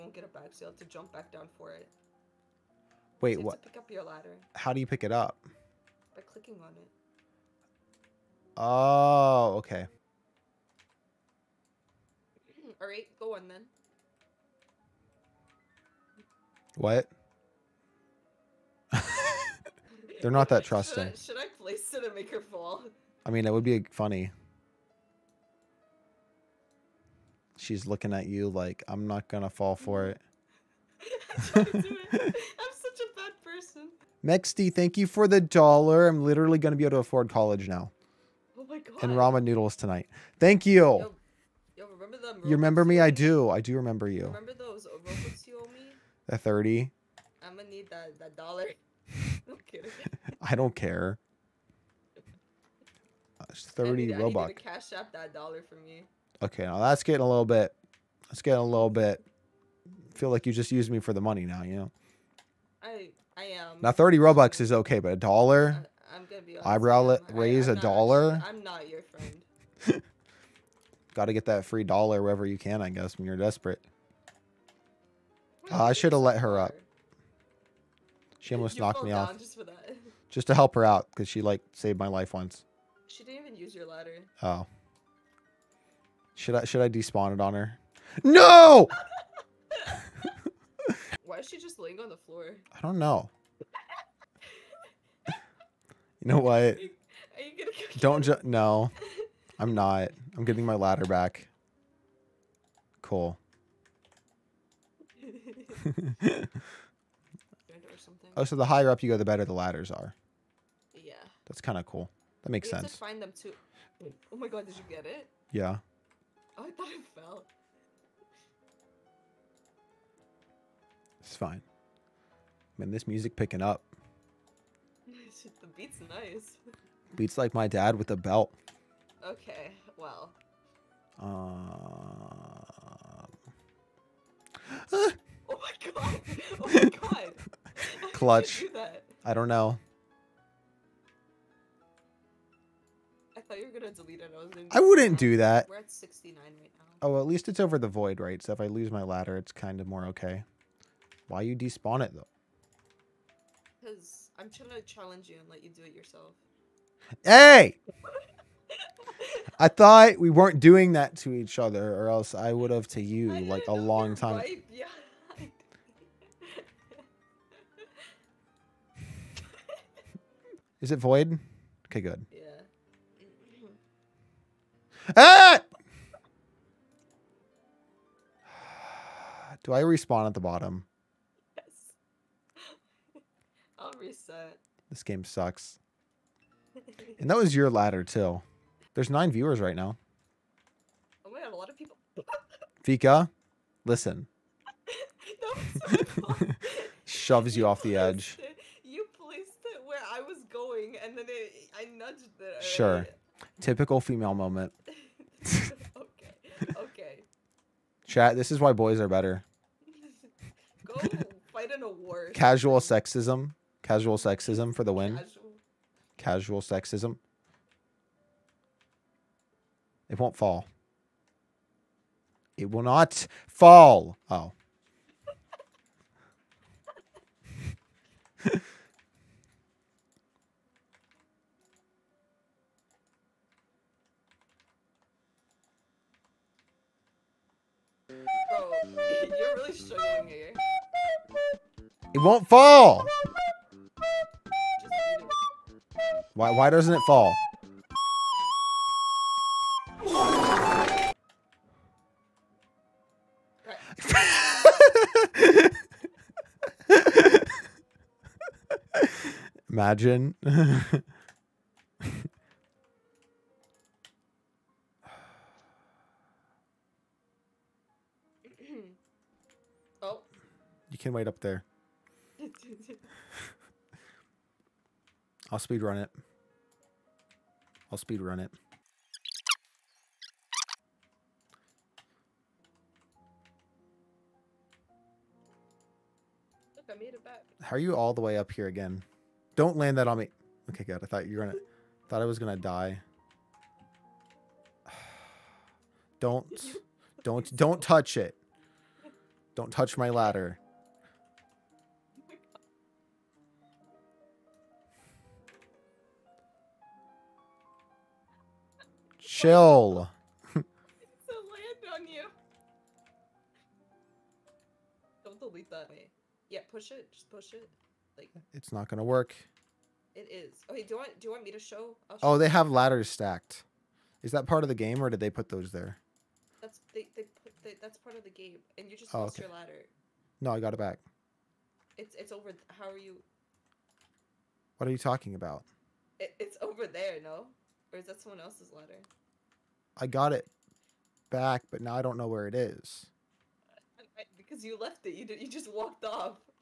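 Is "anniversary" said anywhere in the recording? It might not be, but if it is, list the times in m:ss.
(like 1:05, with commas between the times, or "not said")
not said.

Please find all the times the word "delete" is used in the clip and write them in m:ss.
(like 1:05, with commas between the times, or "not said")
2:23, 5:15.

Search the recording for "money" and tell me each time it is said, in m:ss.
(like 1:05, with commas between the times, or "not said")
1:01.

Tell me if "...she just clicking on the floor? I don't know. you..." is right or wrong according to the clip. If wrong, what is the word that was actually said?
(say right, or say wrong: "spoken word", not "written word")
wrong: "laying", not "clicking".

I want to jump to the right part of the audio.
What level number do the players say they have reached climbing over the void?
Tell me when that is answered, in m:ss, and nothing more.
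2:25.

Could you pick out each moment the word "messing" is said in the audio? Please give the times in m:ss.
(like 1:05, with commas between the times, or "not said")
not said.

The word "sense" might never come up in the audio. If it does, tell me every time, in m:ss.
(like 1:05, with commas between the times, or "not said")
1:52.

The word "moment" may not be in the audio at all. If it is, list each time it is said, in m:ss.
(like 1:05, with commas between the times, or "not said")
3:24.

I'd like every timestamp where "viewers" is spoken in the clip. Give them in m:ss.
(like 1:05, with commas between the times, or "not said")
3:09.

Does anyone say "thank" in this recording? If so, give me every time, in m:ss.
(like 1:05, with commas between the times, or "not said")
0:34, 0:40.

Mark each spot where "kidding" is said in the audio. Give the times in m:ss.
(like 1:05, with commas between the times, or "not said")
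0:49.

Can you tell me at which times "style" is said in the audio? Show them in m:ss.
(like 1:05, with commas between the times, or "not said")
not said.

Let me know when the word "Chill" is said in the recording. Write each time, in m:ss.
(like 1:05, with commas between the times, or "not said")
5:09.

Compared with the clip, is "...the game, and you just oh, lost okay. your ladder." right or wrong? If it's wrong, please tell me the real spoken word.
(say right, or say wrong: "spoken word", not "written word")
right.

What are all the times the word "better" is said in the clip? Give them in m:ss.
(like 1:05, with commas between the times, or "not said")
1:49, 3:29.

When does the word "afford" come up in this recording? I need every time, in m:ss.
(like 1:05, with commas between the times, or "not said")
0:36.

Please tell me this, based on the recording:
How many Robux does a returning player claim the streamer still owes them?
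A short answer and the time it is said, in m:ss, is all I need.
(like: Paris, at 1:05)
30, at 0:46.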